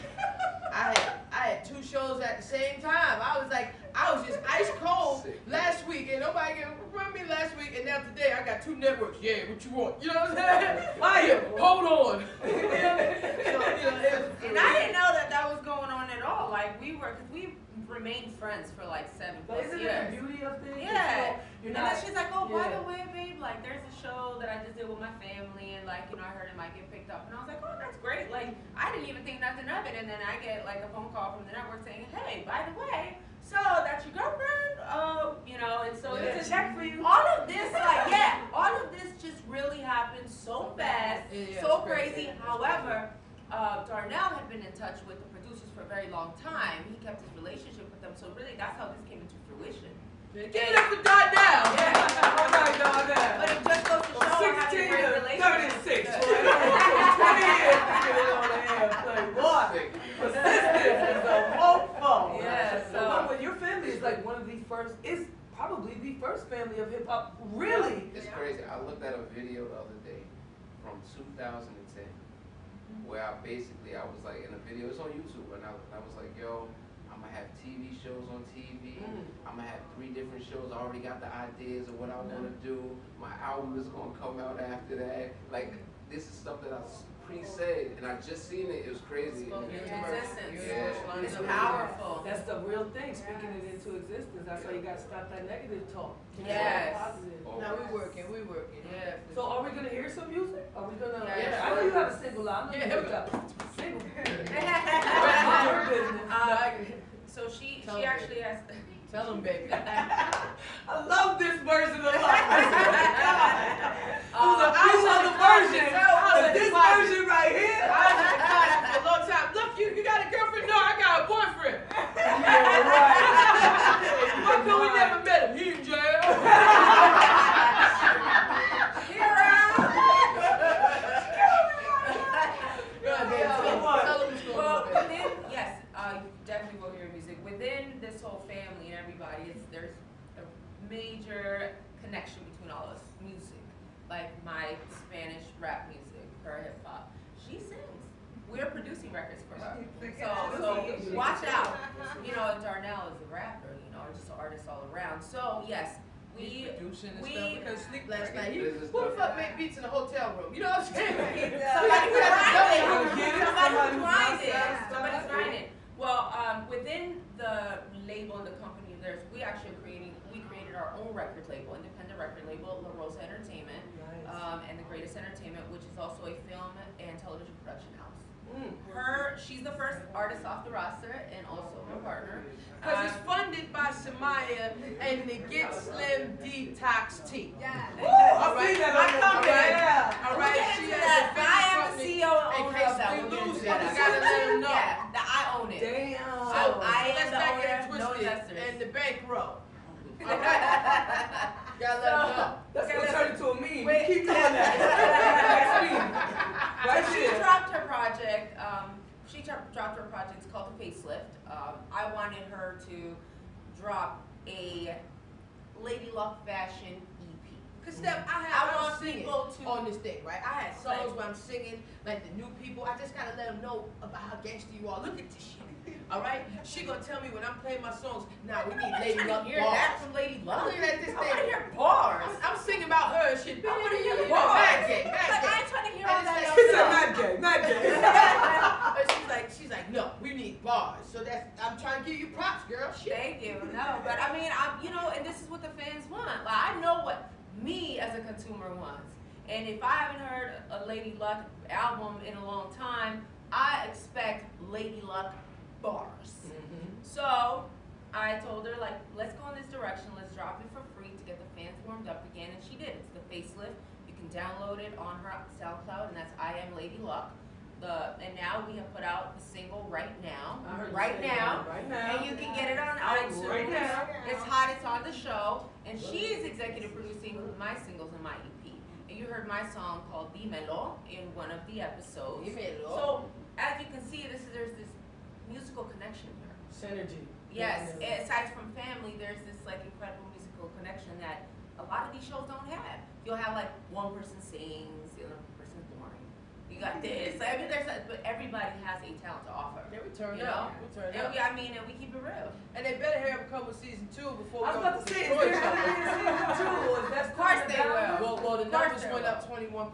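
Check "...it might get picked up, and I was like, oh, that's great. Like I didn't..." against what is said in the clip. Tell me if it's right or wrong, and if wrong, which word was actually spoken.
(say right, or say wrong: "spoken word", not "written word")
right.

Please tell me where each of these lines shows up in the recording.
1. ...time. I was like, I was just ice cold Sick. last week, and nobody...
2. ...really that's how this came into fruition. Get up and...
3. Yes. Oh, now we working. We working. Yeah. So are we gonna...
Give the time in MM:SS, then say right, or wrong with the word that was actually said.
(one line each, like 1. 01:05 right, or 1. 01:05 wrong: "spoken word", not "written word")
1. 00:02 right
2. 00:48 right
3. 01:36 right.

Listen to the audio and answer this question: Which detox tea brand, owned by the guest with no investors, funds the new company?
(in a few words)
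Get Slim Detox Tea.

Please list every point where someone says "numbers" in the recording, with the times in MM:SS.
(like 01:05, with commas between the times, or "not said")
05:08.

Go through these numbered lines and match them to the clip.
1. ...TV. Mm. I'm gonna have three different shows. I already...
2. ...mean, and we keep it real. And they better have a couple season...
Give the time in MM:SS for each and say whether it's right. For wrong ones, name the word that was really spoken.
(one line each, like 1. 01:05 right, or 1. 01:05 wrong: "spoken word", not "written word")
1. 01:18 right
2. 05:01 right.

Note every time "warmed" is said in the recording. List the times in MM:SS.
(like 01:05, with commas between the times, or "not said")
04:21.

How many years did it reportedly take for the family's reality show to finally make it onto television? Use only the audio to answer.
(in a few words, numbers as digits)
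20.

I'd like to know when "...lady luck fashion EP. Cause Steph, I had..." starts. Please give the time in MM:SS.
03:35.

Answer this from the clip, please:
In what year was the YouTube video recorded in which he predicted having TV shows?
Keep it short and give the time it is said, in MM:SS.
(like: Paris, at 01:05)
2010, at 01:11.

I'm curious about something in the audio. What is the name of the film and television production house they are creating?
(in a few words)
The Greatest Entertainment.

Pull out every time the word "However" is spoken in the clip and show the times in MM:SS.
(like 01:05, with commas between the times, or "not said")
00:42.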